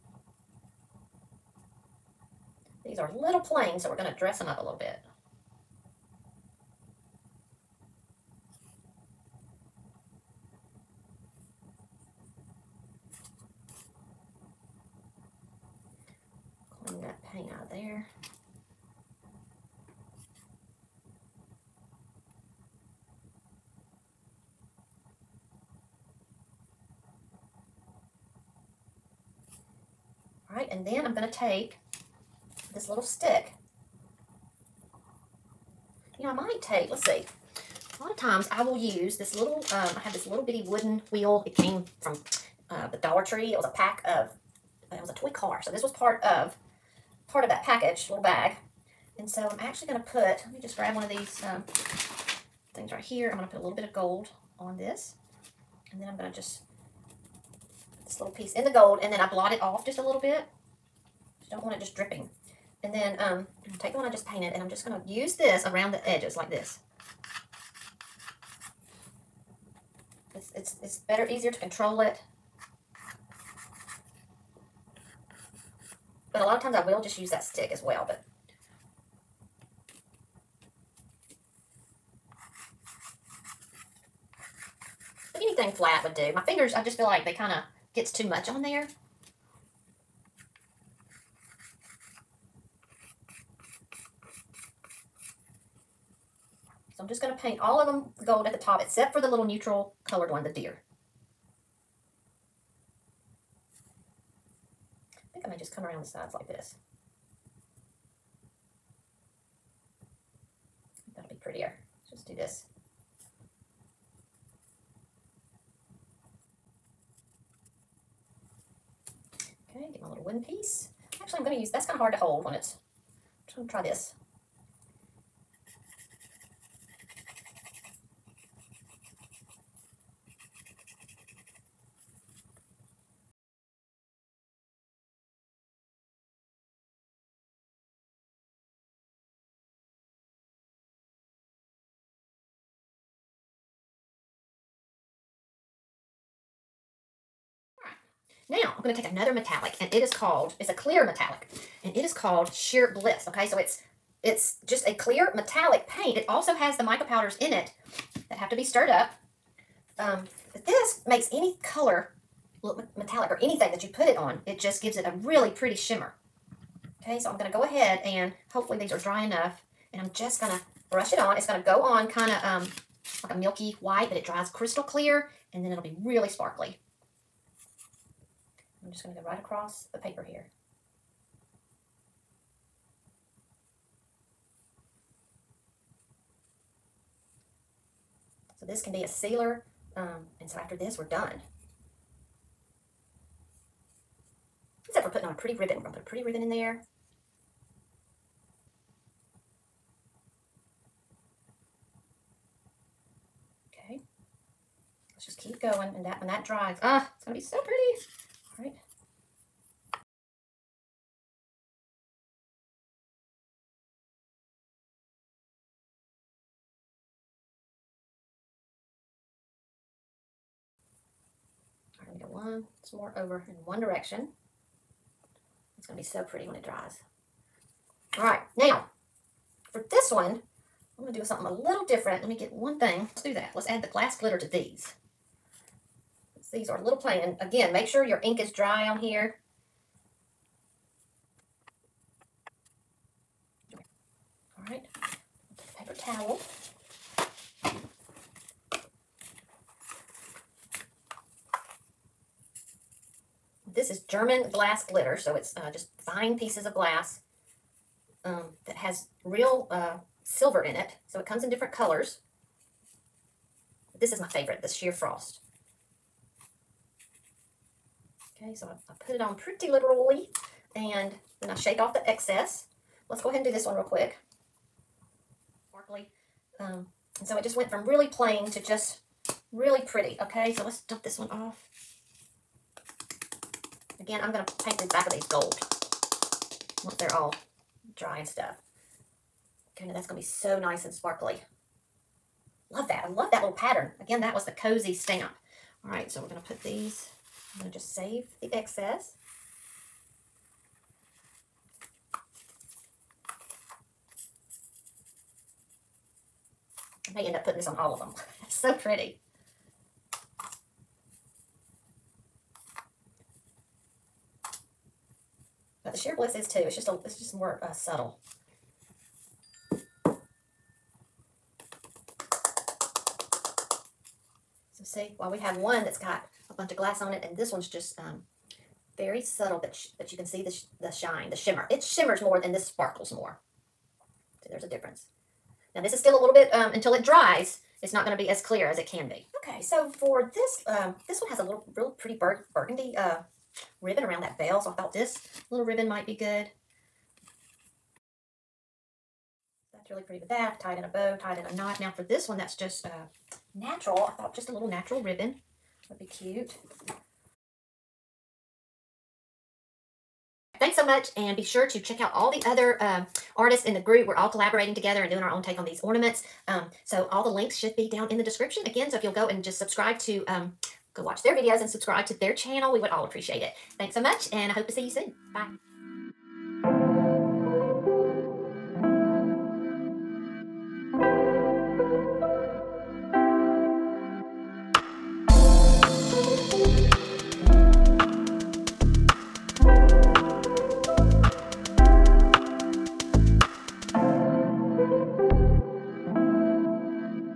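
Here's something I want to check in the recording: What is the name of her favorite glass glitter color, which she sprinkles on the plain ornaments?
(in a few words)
Sheer Frost.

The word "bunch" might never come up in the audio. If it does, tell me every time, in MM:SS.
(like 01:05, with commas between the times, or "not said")
05:26.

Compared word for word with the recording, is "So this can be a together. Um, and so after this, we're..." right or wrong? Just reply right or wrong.
wrong.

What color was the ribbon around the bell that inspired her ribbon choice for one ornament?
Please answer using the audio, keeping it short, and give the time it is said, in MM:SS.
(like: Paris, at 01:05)
Burgundy, at 05:42.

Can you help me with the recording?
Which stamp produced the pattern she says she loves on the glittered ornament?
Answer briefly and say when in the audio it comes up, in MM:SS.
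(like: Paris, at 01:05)
The cozy stamp, at 04:54.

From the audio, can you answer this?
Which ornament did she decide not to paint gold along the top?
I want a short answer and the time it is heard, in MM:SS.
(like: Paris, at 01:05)
The deer, at 01:40.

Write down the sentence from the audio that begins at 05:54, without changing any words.
I thought just a little natural ribbon would be cute.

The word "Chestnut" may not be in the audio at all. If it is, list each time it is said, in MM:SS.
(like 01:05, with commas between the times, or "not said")
not said.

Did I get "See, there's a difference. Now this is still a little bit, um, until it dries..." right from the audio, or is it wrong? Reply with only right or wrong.
right.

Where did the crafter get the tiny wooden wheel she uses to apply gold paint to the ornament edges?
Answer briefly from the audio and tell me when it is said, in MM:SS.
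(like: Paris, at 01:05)
Dollar Tree, at 00:42.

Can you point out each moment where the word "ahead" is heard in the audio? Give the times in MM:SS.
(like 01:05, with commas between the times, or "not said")
02:47, 04:33.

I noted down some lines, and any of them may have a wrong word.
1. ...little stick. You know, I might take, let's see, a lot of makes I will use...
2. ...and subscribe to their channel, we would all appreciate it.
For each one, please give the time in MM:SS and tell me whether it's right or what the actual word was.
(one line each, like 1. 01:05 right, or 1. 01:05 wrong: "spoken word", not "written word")
1. 00:32 wrong: "times", not "makes"
2. 06:11 right.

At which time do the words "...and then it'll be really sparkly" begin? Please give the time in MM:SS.
02:55.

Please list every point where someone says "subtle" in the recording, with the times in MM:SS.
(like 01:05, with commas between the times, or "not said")
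05:17, 05:29.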